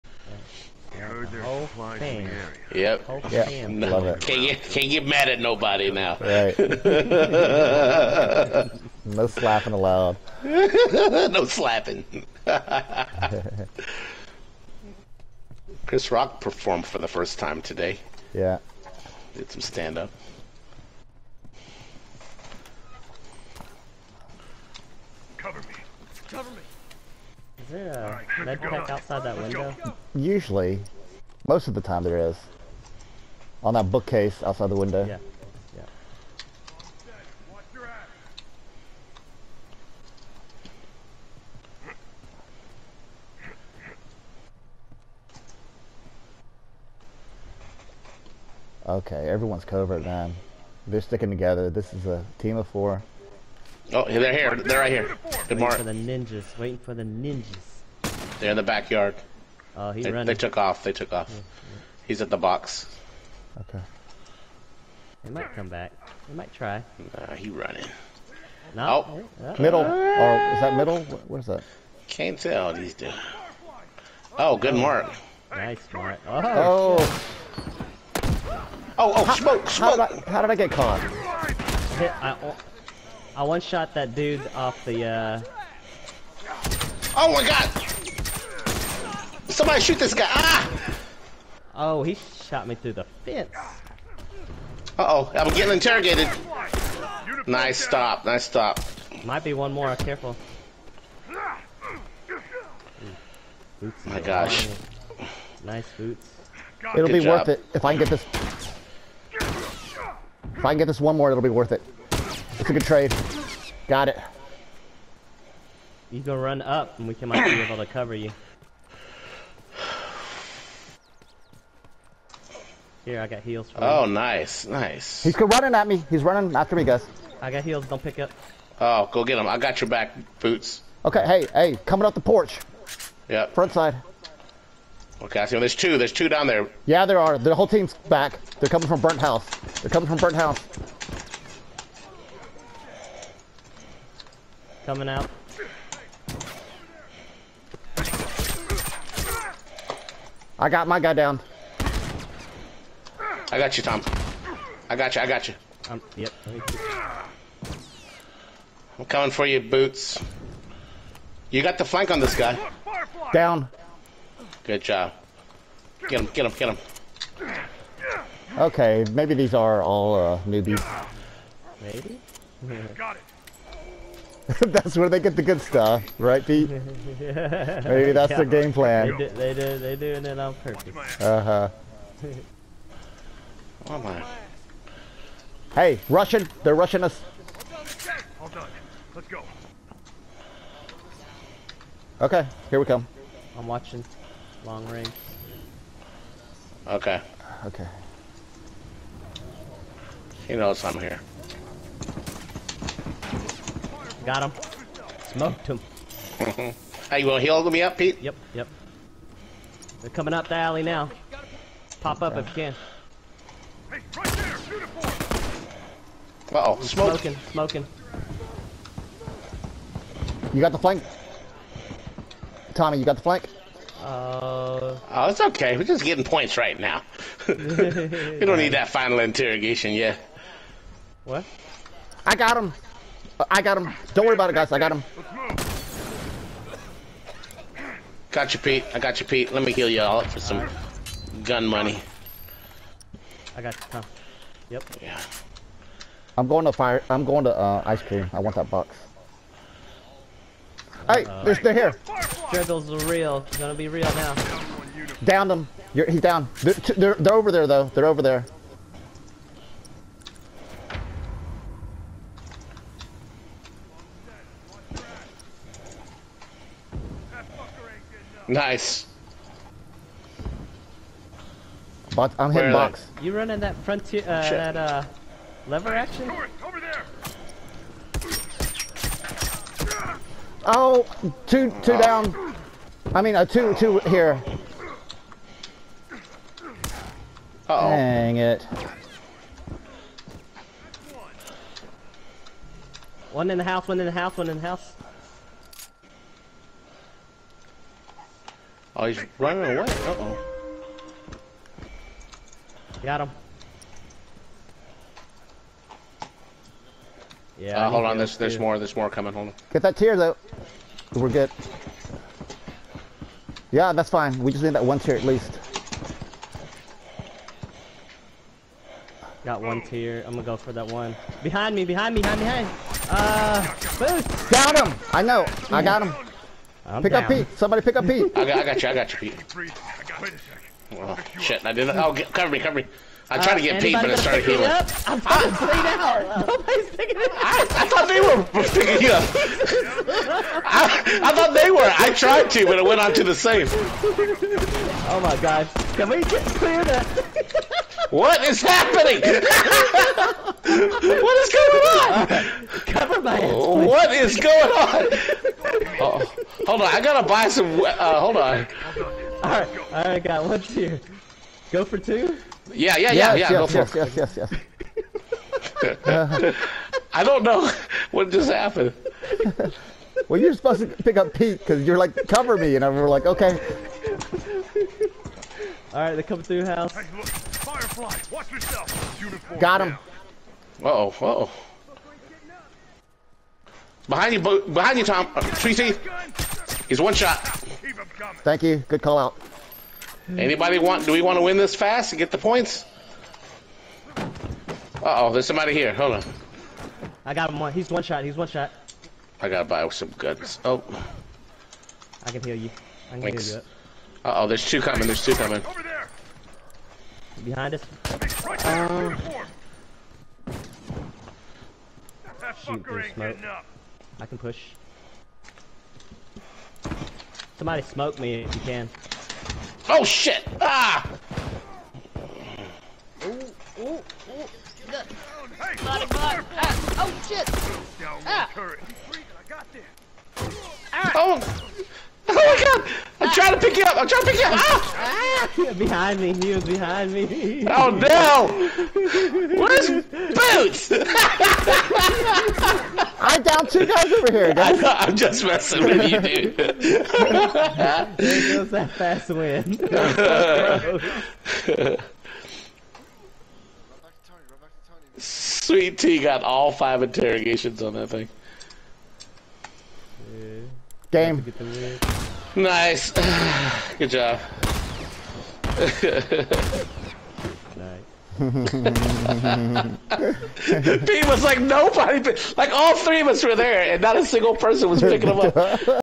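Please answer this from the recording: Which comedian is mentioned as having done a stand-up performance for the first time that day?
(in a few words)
Chris Rock.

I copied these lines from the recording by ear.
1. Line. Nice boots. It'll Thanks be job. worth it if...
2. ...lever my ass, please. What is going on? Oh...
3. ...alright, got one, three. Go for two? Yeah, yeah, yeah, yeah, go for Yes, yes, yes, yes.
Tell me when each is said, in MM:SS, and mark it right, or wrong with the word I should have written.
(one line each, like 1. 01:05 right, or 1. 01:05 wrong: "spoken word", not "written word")
1. 01:44 wrong: "Good", not "Thanks"
2. 05:52 wrong: "cover", not "lever"
3. 05:59 wrong: "two", not "three".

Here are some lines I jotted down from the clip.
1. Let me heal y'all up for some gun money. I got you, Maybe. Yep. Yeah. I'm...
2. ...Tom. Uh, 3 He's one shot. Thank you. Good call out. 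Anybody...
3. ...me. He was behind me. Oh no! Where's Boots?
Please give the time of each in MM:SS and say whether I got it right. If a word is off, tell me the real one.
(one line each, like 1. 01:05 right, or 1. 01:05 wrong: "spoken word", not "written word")
1. 03:59 wrong: "Tom", not "Maybe"
2. 06:25 right
3. 07:16 right.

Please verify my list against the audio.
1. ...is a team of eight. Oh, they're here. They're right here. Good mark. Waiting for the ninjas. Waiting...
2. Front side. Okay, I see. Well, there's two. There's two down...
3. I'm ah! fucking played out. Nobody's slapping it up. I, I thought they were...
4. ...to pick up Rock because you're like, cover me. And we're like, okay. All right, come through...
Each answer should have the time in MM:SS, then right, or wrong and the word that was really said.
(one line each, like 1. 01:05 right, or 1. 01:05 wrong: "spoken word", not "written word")
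1. 00:51 wrong: "four", not "eight"
2. 02:13 right
3. 05:34 wrong: "picking", not "slapping"
4. 06:10 wrong: "Pete", not "Rock".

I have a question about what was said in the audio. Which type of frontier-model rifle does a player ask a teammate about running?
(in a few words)
Lever action.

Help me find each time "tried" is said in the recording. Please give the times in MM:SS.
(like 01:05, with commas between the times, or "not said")
05:33, 05:42.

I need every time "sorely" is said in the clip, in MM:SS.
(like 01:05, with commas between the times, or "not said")
not said.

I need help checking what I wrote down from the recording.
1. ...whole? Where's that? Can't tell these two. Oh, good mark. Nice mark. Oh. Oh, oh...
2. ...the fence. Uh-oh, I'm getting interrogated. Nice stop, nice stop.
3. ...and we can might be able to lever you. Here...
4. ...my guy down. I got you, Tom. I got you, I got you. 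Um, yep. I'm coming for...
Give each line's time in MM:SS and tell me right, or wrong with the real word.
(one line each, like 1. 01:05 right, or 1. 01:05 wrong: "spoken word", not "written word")
1. 01:10 wrong: "middle", not "whole"
2. 01:32 right
3. 01:56 wrong: "cover", not "lever"
4. 02:30 right.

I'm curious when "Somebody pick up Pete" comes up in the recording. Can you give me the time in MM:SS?
05:27.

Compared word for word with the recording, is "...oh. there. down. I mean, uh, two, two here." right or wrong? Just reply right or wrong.
right.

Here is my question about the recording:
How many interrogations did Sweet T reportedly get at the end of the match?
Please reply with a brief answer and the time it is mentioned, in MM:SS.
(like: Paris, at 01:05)
5, at 07:36.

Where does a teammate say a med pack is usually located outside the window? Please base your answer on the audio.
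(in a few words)
On that bookcase.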